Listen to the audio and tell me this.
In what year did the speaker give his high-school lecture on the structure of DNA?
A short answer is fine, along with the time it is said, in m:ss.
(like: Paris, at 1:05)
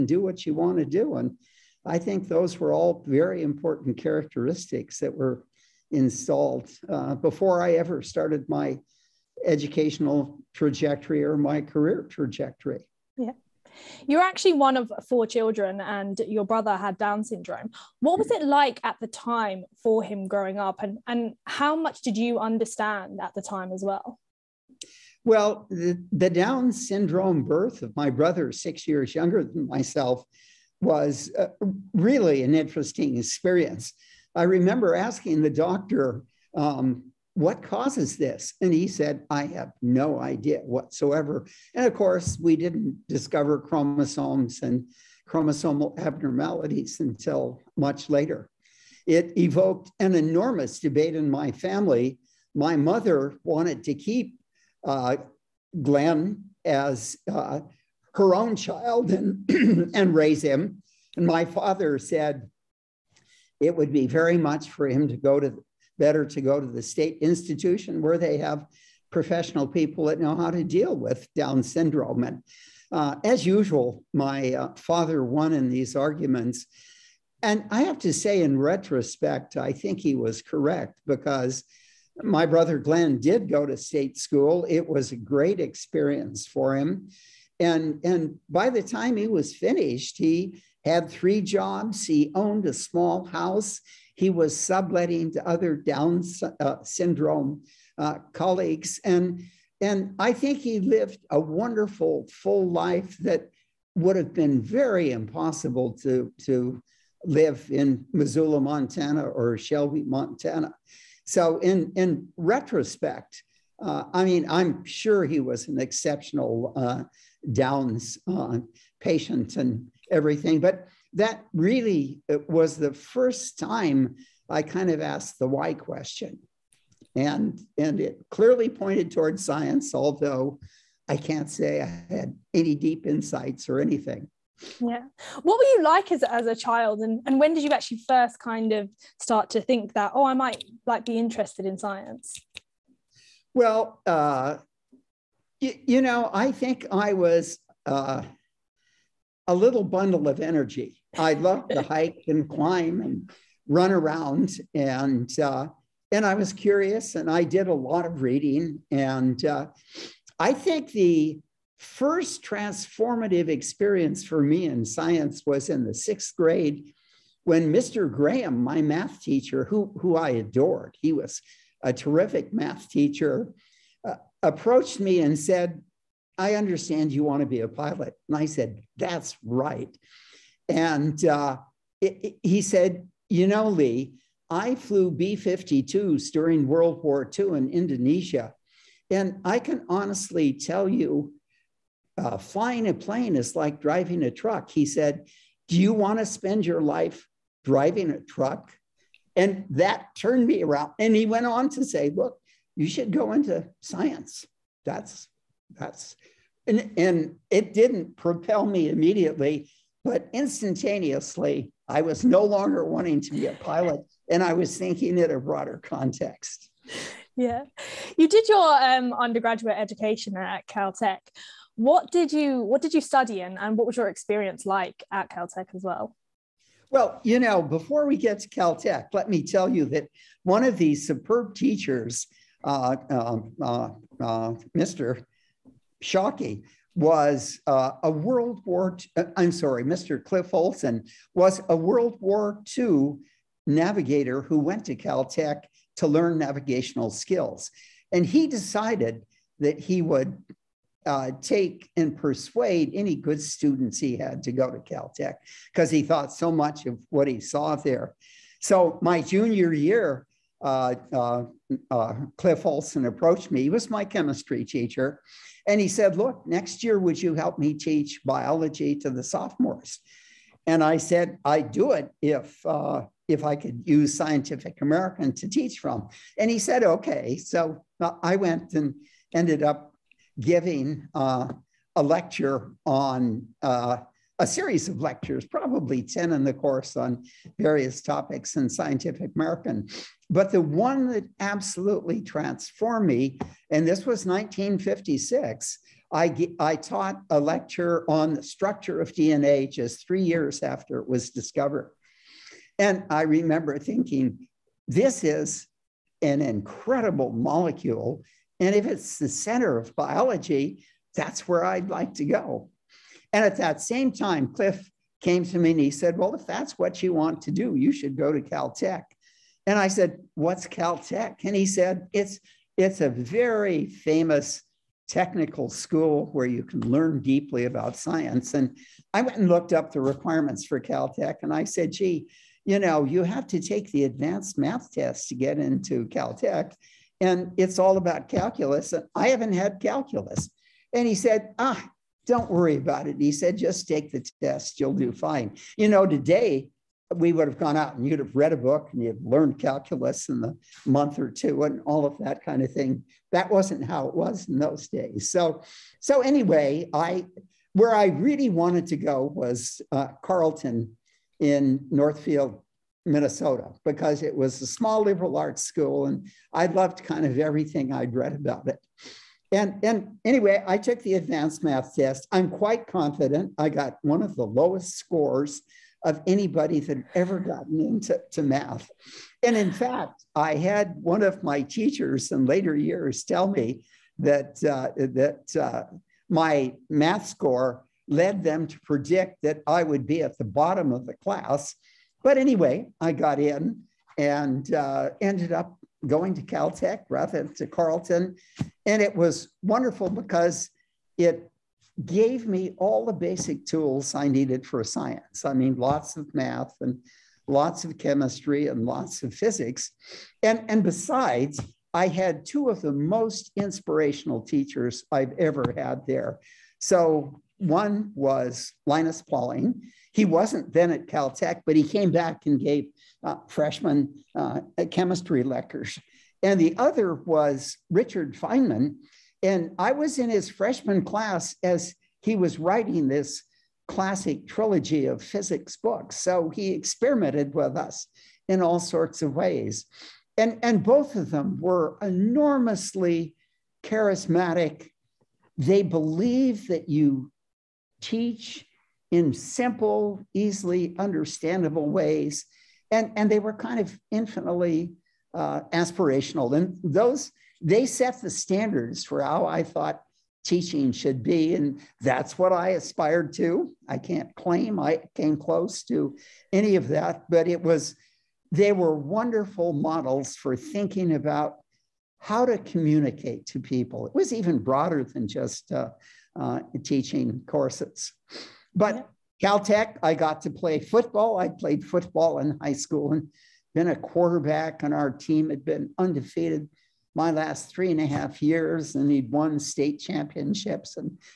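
1956, at 4:54.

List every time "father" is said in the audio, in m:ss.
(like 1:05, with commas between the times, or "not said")
1:01, 1:14.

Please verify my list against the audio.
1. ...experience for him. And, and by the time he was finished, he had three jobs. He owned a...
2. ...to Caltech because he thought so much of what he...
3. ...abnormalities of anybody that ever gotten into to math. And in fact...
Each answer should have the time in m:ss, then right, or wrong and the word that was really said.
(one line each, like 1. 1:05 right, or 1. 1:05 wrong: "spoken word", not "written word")
1. 1:25 right
2. 4:14 right
3. 6:14 wrong: "scores", not "abnormalities".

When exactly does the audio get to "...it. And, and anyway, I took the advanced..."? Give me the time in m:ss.
6:08.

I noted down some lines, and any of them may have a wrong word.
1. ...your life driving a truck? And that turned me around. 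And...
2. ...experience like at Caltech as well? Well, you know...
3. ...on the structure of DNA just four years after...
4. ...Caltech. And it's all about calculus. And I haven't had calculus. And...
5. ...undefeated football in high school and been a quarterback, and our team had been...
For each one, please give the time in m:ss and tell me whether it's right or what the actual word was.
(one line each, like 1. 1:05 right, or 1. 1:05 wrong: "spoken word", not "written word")
1. 3:16 right
2. 3:44 right
3. 4:58 wrong: "three", not "four"
4. 5:36 right
5. 8:01 wrong: "played", not "undefeated".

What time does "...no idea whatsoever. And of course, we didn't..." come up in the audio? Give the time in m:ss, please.
0:39.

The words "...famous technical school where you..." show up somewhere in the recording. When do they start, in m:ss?
5:23.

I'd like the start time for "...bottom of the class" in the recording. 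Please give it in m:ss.
6:30.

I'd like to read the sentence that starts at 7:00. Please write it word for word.
He wasn't then at Caltech, but he came back and gave uh, freshman uh, chemistry lectures.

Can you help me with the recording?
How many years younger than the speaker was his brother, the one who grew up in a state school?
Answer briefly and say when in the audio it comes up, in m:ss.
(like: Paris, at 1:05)
6, at 0:28.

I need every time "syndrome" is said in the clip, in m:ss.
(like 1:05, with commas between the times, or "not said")
0:17, 0:26, 1:11, 1:36.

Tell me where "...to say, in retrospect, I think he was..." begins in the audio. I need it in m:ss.
1:17.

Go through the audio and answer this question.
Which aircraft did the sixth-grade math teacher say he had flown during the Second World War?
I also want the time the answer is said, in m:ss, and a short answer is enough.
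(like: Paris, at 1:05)
B-52s, at 3:05.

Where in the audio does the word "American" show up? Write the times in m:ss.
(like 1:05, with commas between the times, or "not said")
4:34, 4:49.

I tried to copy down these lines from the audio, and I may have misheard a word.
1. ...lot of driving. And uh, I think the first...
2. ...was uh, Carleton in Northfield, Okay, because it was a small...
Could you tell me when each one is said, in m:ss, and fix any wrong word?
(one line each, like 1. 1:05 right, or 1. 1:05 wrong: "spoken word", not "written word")
1. 2:37 wrong: "reading", not "driving"
2. 5:59 wrong: "Minnesota", not "Okay".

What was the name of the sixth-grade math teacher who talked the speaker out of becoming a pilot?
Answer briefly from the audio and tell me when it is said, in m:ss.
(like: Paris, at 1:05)
Mr. Graham, at 2:47.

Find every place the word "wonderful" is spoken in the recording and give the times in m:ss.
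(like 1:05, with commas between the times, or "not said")
1:41, 6:39, 7:48.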